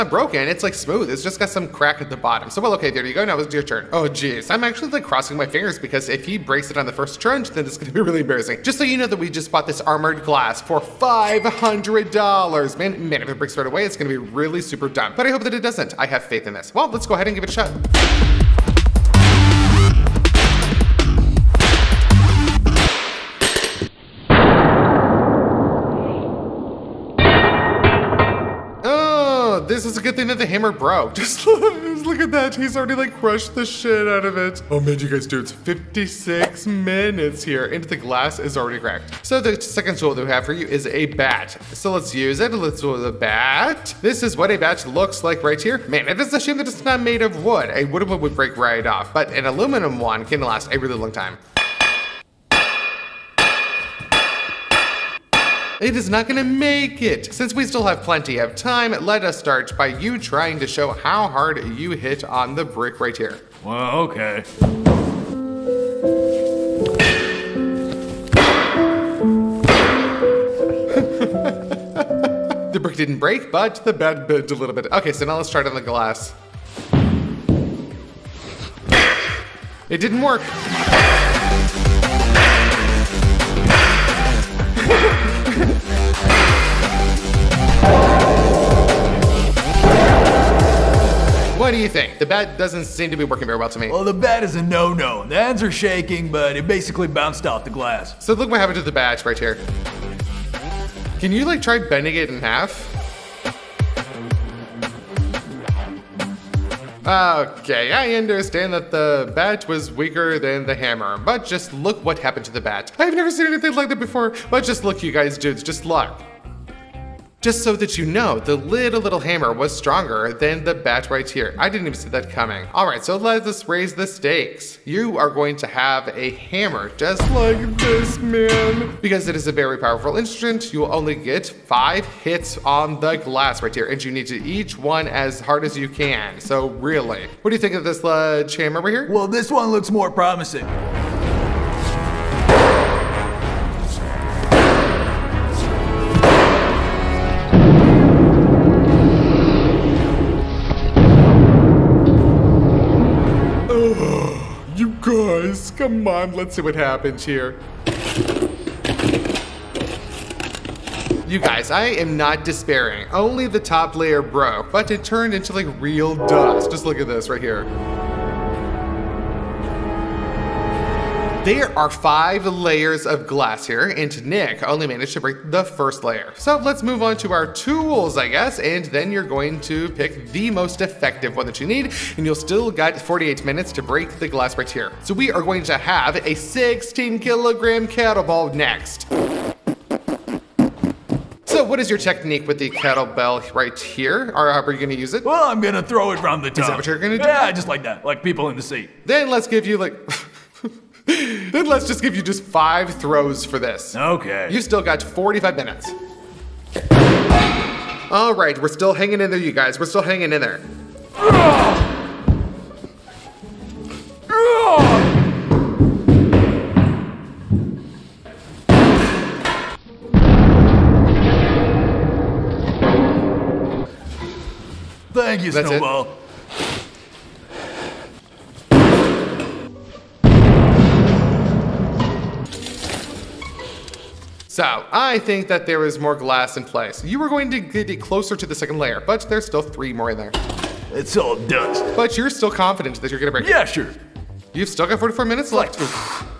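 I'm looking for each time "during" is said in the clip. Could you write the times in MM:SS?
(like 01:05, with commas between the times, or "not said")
not said.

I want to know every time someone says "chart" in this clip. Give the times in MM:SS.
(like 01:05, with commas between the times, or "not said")
not said.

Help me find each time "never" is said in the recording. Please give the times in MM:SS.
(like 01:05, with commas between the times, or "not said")
01:53.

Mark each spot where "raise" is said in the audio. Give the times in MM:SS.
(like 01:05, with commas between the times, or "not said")
02:03.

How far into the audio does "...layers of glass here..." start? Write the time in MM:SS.
02:52.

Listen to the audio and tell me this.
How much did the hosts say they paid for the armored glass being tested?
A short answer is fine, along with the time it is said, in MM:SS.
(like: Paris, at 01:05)
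$500, at 00:10.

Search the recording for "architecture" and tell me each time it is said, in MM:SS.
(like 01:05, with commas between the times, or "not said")
not said.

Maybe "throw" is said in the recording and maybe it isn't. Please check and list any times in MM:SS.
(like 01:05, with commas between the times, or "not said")
03:15, 03:22.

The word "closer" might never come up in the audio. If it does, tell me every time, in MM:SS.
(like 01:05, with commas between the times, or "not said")
03:57.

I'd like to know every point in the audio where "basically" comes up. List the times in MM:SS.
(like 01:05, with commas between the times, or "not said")
01:36.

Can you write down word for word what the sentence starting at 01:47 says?
Okay, I understand that the bat was weaker than the hammer, but just look what happened to the bat.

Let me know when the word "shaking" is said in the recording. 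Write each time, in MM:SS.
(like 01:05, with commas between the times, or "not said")
01:35.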